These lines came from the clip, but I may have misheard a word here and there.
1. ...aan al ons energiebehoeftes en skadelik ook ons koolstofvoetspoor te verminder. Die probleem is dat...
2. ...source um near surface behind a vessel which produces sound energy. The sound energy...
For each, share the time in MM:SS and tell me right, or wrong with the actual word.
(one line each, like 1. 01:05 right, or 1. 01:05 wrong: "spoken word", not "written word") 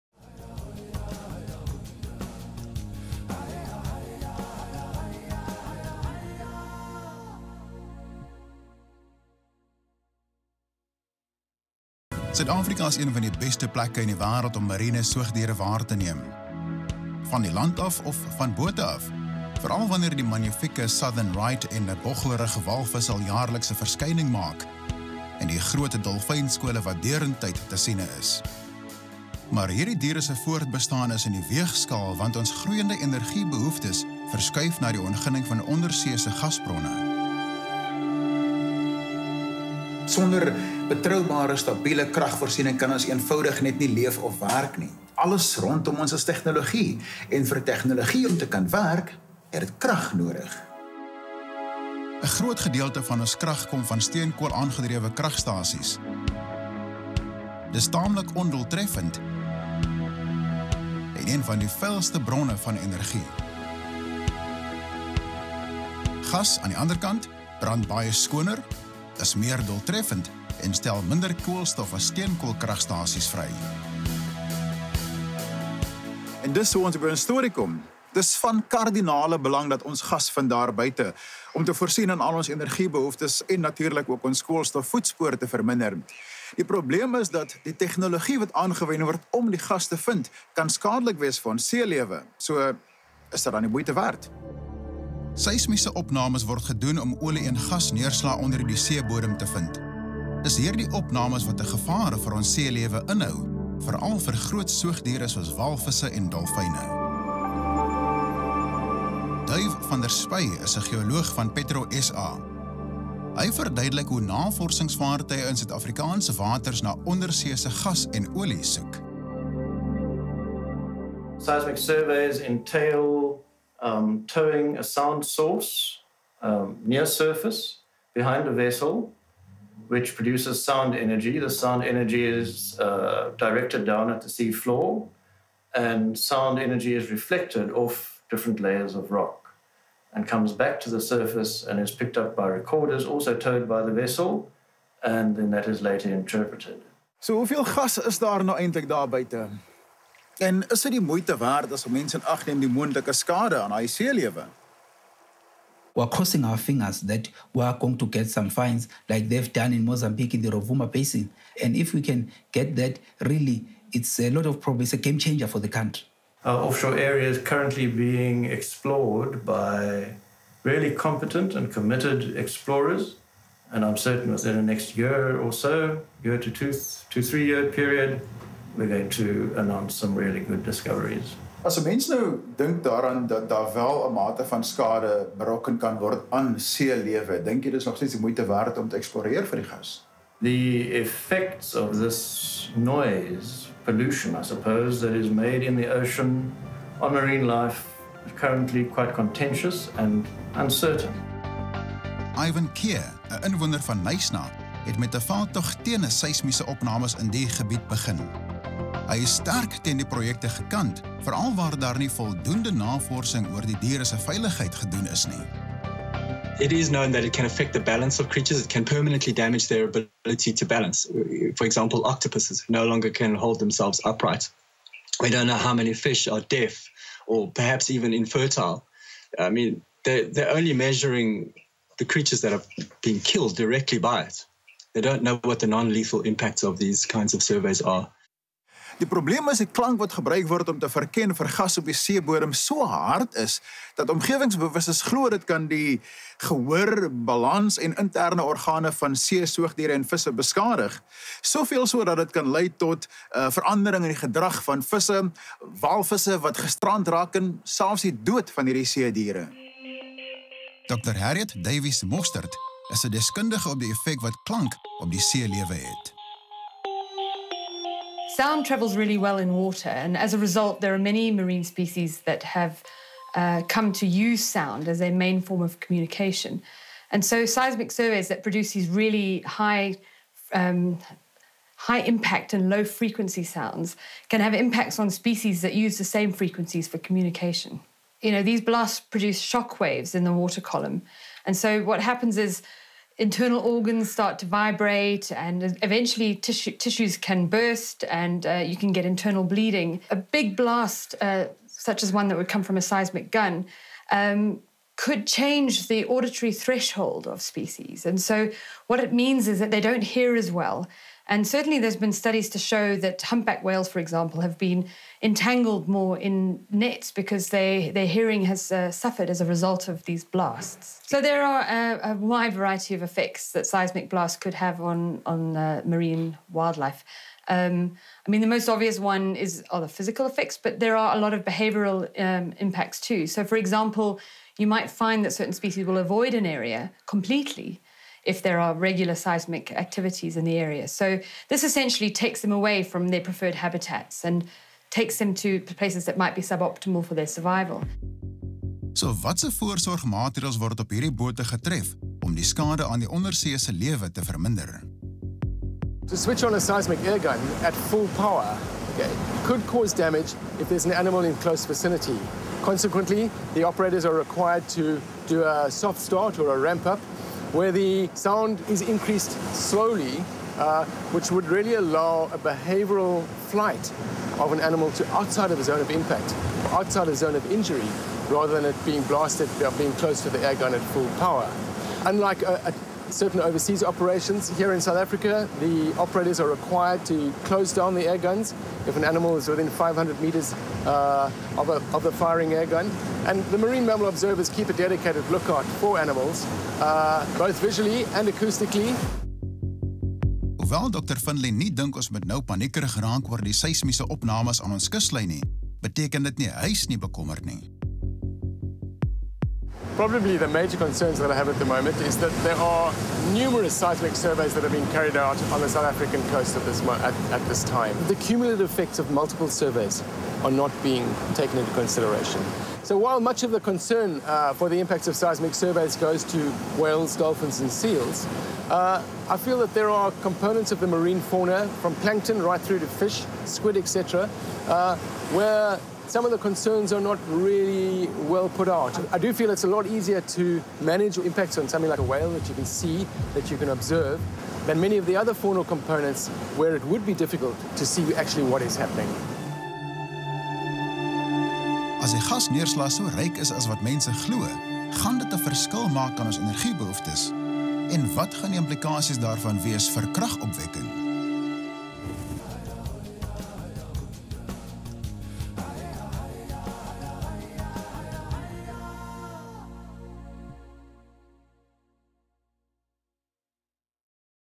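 1. 01:22 wrong: "natuurlik", not "skadelik"
2. 02:05 right.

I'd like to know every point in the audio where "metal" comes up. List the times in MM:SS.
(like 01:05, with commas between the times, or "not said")
not said.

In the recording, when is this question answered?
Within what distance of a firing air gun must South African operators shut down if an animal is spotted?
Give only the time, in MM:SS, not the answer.
06:29.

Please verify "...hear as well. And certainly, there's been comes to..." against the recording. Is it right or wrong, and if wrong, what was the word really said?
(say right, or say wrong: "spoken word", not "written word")
wrong: "studies", not "comes".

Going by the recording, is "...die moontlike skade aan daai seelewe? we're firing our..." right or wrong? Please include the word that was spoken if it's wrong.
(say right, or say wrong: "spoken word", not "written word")
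wrong: "crossing", not "firing".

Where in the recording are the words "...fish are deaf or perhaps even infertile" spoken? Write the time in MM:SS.
03:45.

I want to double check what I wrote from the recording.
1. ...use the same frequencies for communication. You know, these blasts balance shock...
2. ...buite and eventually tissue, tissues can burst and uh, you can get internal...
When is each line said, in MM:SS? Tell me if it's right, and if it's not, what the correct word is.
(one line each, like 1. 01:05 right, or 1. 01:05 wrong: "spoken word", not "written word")
1. 04:45 wrong: "produce", not "balance"
2. 04:54 wrong: "vibrate", not "buite".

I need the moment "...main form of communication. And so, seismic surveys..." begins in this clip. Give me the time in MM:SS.
04:35.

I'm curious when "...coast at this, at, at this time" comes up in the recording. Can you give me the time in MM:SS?
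06:56.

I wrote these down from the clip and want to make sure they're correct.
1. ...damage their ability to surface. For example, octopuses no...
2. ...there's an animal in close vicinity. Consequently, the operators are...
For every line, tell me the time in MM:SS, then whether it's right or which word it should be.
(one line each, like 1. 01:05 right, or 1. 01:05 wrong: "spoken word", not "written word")
1. 03:39 wrong: "balance", not "surface"
2. 06:00 right.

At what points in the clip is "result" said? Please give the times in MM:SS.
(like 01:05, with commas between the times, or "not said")
04:30, 05:19.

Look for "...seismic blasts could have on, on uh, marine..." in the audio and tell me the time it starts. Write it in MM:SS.
05:23.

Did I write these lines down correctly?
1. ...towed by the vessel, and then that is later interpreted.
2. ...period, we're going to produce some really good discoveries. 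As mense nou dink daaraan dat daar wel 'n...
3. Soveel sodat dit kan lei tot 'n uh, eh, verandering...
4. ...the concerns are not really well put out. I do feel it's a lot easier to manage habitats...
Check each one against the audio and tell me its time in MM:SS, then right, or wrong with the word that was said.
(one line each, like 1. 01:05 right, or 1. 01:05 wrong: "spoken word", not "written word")
1. 02:23 right
2. 02:57 wrong: "announce", not "produce"
3. 04:11 right
4. 07:16 wrong: "impacts", not "habitats".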